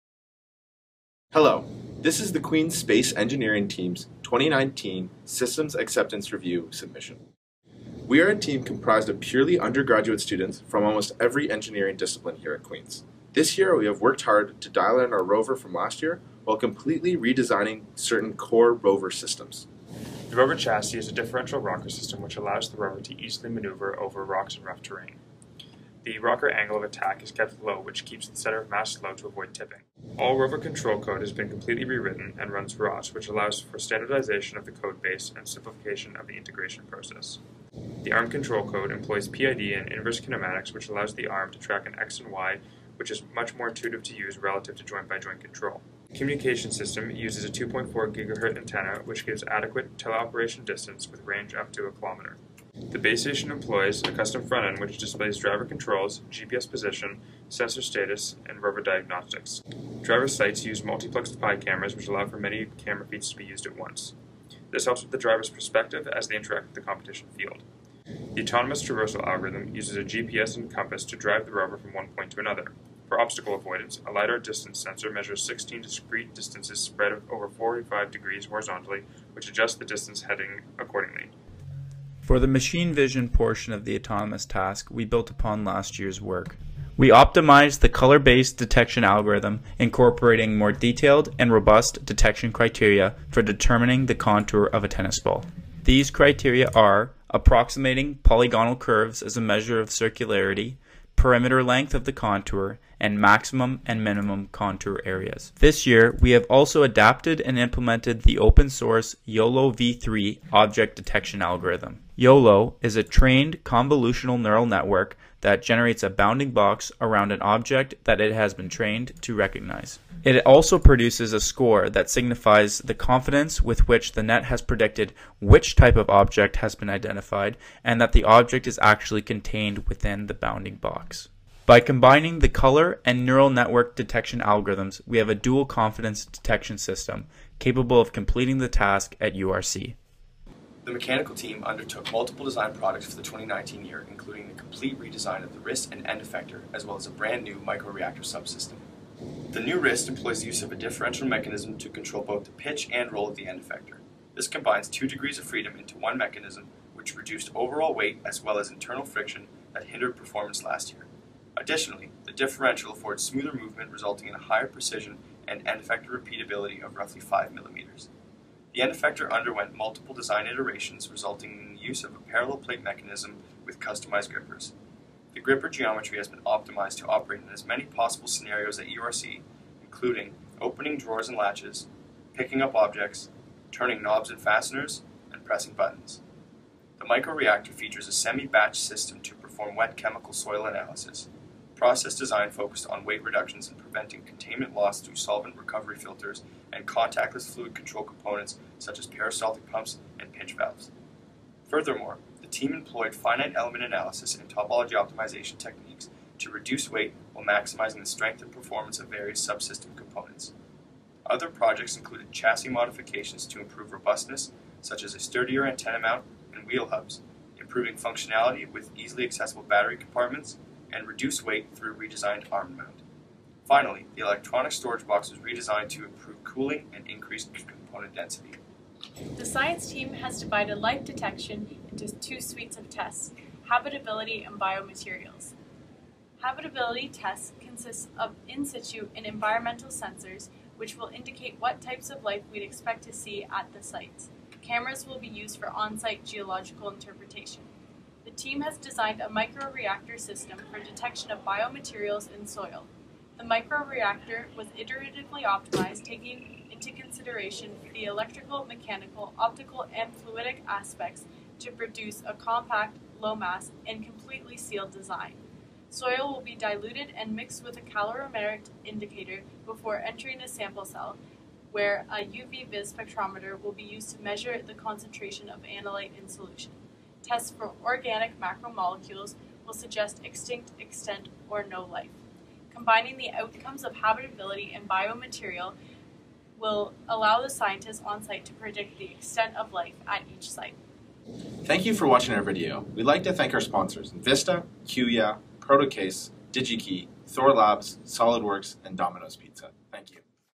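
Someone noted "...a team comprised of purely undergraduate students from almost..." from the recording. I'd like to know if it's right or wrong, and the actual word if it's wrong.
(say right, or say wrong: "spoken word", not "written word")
right.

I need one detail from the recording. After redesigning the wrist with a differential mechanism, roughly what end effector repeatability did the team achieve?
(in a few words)
5 millimeters.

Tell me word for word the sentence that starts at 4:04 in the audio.
Cameras will be used for on-site geological interpretation the team has designed a microreactor system for detection of biomaterials in soil.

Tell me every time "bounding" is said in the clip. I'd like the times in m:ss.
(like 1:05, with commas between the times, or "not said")
1:56, 2:10.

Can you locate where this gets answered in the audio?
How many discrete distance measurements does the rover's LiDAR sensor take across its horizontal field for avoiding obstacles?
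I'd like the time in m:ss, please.
1:15.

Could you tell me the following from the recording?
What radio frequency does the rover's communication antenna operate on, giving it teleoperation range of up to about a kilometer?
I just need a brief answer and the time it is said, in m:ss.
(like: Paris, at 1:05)
2.4 GHz, at 0:47.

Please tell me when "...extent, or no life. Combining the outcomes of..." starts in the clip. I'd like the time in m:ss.
4:40.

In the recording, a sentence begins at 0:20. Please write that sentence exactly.
The rover chassis is a differential rocker system which allows the rover to easily maneuver over rocks and rough terrain.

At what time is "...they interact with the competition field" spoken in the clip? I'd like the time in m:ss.
1:06.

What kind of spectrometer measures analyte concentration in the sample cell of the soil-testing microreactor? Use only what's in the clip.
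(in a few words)
UV-vis spectrometer.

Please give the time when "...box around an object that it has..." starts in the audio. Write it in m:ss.
1:56.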